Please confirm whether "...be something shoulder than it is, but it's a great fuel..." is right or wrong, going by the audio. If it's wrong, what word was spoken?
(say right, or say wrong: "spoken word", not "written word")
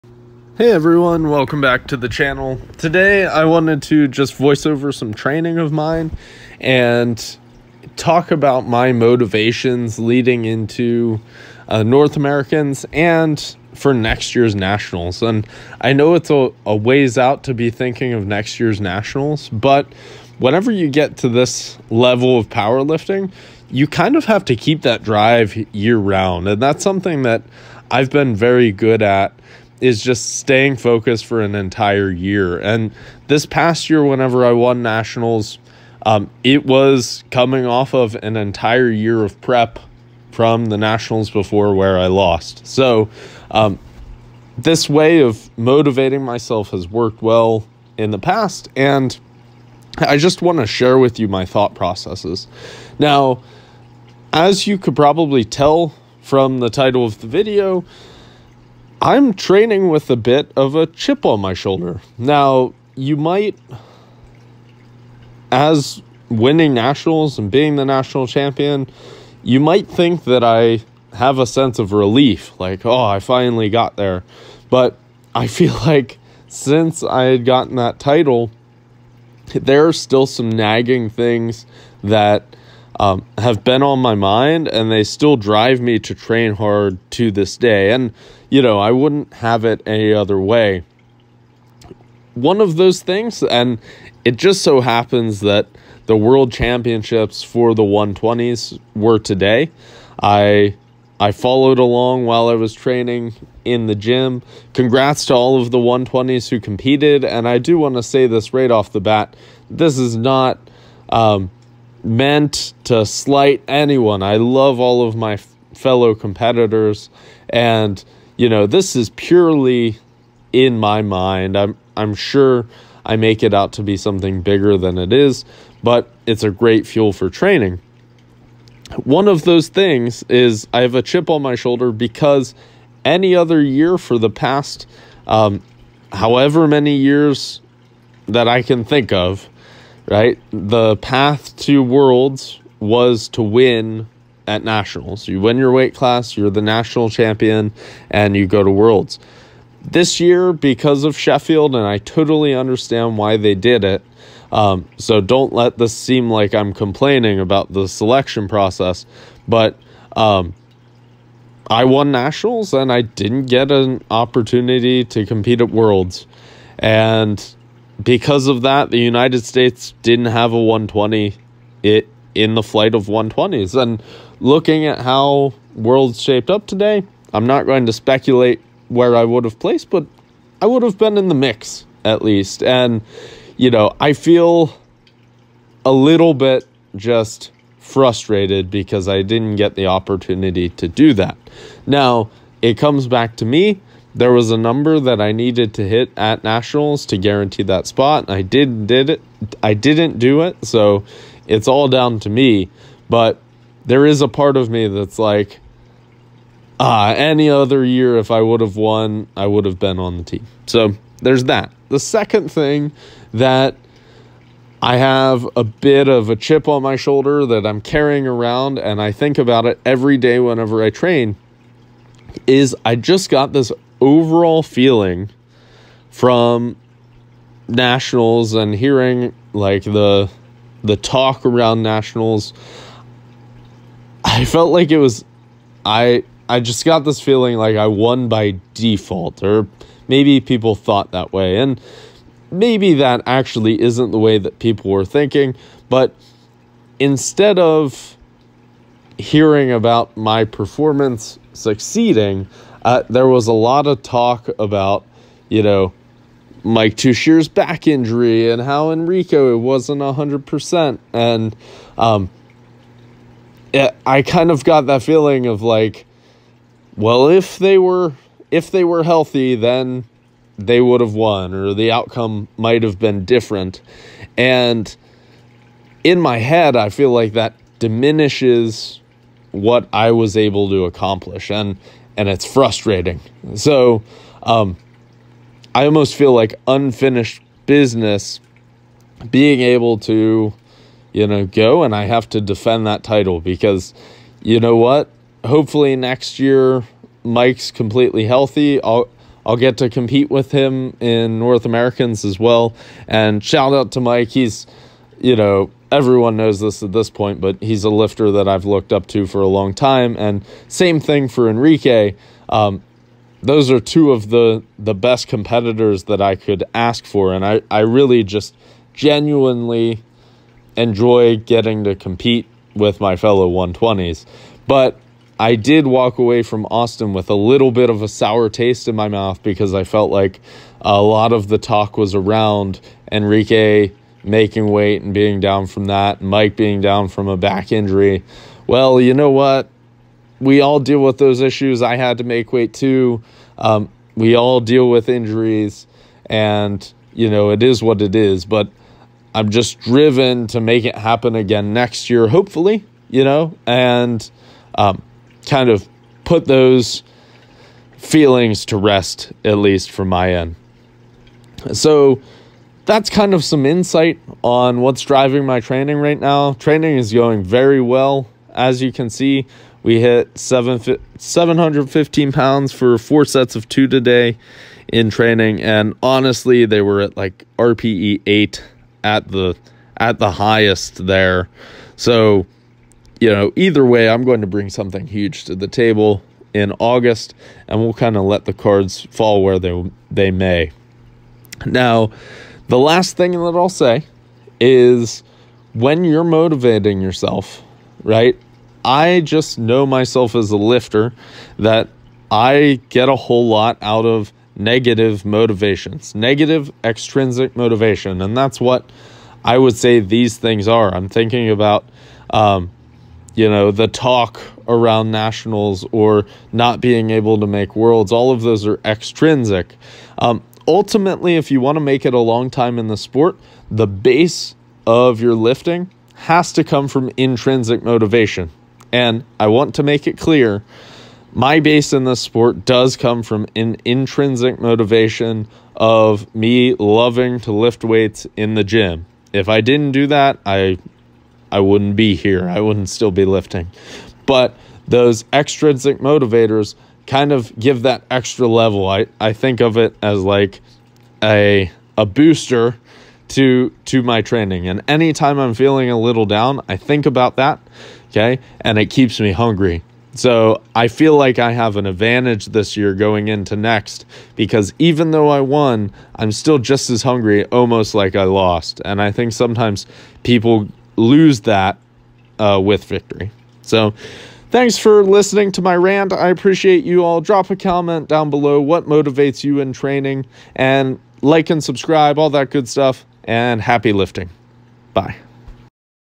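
wrong: "bigger", not "shoulder".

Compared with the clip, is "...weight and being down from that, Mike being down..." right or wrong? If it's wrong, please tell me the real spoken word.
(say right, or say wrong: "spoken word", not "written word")
right.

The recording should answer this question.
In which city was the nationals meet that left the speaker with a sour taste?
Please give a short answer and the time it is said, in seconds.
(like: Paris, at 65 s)
Austin, at 326 s.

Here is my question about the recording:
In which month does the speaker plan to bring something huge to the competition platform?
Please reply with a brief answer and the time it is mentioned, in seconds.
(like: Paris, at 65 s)
August, at 386 s.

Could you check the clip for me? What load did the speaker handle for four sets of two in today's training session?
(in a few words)
715 pounds.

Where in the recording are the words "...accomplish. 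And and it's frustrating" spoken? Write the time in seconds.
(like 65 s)
280 s.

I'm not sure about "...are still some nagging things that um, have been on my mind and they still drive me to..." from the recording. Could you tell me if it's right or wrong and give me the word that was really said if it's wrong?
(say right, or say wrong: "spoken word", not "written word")
right.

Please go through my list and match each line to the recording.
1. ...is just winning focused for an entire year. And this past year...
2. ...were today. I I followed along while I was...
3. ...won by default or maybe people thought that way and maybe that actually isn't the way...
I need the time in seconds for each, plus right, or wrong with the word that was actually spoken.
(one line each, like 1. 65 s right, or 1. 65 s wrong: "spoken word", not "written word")
1. 29 s wrong: "staying", not "winning"
2. 98 s right
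3. 237 s right.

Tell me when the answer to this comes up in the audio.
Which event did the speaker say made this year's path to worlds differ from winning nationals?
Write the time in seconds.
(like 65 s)
151 s.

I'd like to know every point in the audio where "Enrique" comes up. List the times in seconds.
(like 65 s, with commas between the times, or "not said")
258 s, 311 s, 333 s.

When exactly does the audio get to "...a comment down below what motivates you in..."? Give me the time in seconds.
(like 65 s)
477 s.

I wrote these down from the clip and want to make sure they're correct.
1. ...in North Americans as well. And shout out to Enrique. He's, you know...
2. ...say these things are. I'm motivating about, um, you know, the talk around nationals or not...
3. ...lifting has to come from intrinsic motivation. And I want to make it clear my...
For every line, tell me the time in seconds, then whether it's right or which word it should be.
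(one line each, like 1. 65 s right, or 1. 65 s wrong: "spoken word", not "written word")
1. 300 s wrong: "Mike", not "Enrique"
2. 409 s wrong: "thinking", not "motivating"
3. 425 s right.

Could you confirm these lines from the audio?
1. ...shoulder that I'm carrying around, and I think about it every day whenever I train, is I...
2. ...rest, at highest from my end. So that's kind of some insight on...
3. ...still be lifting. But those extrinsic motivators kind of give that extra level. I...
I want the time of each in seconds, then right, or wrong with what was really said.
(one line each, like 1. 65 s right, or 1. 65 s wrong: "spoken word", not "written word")
1. 216 s right
2. 358 s wrong: "least", not "highest"
3. 442 s right.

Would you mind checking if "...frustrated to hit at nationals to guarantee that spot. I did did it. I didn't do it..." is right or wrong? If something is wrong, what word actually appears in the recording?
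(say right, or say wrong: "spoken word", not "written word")
wrong: "needed", not "frustrated".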